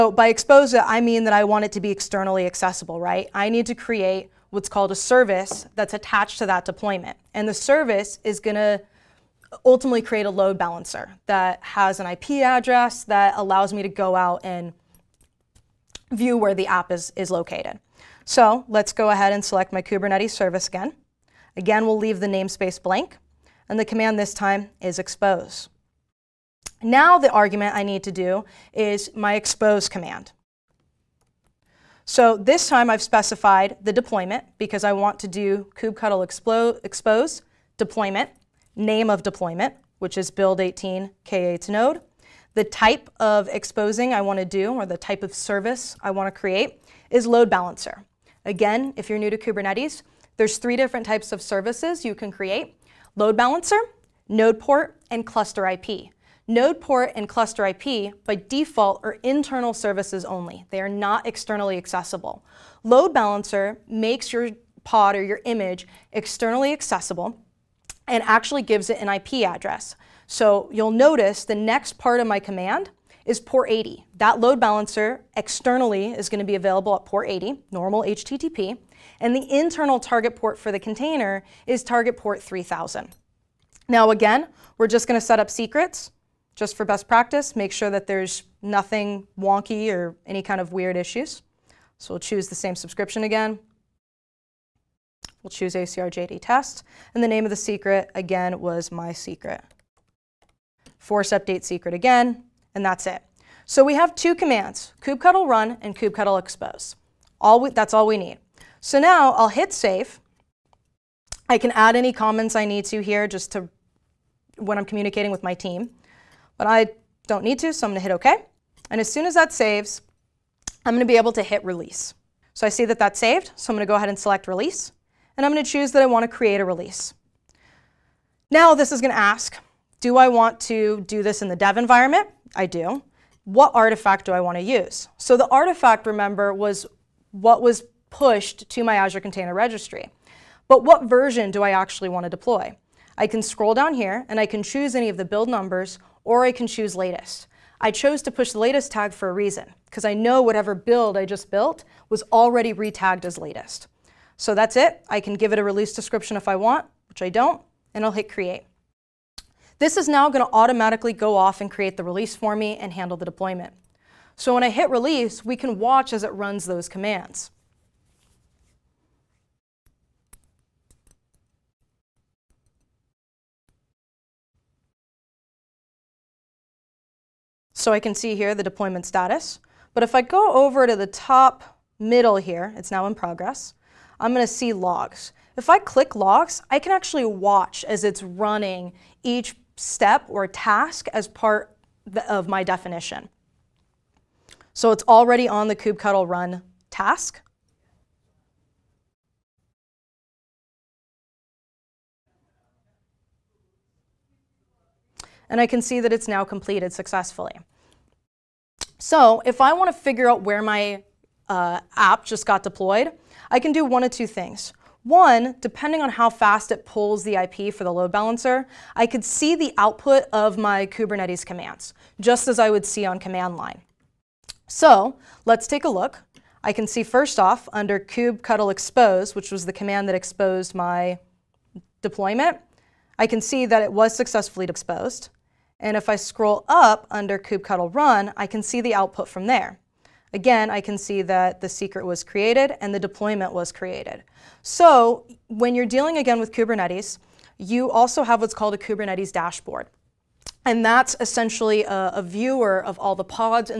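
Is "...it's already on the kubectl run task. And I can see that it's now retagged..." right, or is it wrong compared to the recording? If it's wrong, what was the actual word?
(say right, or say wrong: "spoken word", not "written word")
wrong: "completed", not "retagged".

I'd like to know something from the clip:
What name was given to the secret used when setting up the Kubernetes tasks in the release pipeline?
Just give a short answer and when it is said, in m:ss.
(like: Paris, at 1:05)
my secret, at 1:38.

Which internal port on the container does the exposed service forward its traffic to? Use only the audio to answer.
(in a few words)
3000.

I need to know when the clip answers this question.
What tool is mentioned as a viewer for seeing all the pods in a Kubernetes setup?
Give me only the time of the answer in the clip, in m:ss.
4:08.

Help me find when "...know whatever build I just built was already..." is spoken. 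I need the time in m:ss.
2:30.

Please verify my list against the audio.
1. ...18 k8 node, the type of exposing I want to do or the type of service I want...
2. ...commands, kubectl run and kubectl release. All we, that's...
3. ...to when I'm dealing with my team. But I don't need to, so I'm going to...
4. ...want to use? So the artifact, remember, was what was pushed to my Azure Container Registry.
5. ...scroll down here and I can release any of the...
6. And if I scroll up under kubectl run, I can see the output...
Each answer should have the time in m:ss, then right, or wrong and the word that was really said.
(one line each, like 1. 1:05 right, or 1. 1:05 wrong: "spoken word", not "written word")
1. 0:40 right
2. 1:44 wrong: "expose", not "release"
3. 1:53 wrong: "communicating", not "dealing"
4. 2:14 right
5. 2:23 wrong: "choose", not "release"
6. 3:55 right.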